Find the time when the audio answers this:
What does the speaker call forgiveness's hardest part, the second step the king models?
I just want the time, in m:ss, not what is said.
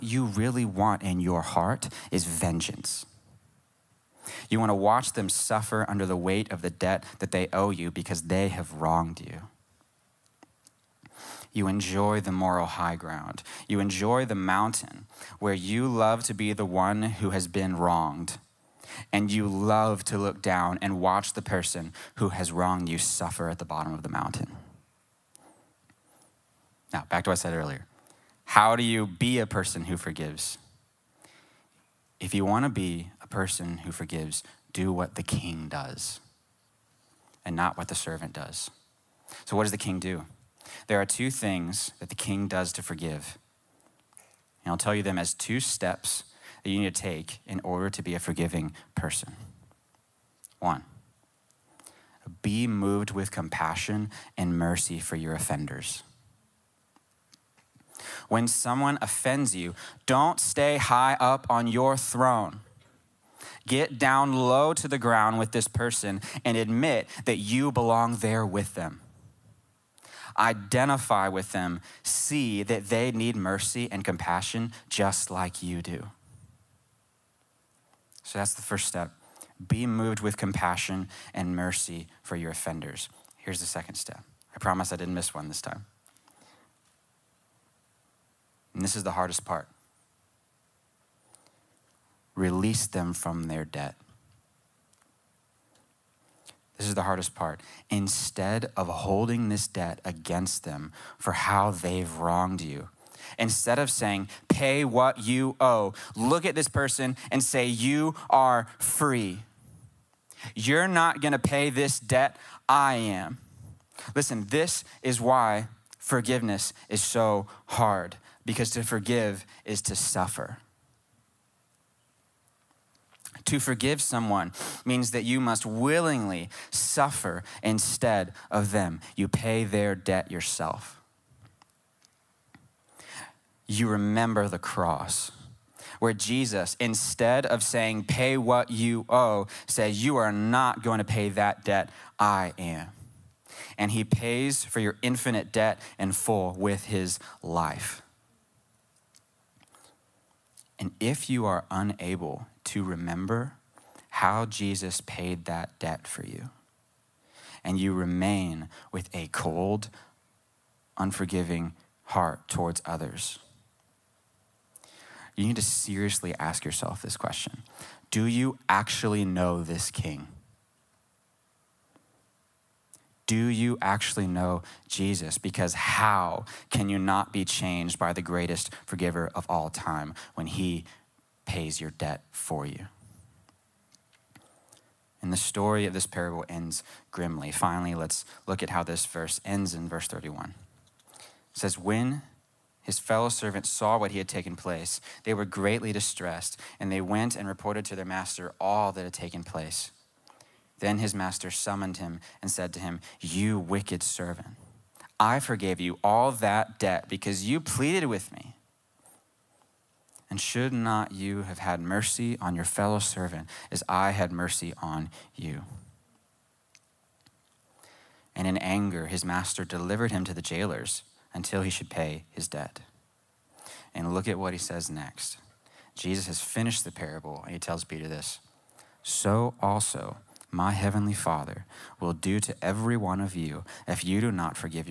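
1:32.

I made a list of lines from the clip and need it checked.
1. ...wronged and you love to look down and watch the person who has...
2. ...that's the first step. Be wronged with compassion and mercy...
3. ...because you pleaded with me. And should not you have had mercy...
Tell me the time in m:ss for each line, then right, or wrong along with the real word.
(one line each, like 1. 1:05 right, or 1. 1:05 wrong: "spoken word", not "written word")
1. 0:17 right
2. 1:18 wrong: "moved", not "wronged"
3. 3:27 right.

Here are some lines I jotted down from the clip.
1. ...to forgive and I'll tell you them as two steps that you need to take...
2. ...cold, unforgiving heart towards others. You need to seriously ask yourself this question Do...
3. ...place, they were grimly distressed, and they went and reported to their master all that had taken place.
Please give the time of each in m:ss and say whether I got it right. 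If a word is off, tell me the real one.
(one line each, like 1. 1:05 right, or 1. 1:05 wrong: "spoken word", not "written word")
1. 0:42 right
2. 2:39 right
3. 3:14 wrong: "greatly", not "grimly".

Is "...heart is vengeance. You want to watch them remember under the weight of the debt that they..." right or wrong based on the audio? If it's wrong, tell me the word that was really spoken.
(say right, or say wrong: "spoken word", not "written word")
wrong: "suffer", not "remember".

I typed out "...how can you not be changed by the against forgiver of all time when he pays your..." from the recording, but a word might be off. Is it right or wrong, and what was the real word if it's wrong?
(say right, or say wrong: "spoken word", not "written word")
wrong: "greatest", not "against".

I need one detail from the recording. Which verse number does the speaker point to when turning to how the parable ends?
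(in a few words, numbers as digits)
31.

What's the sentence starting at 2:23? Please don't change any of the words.
And he pays for your infinite debt in full with his life.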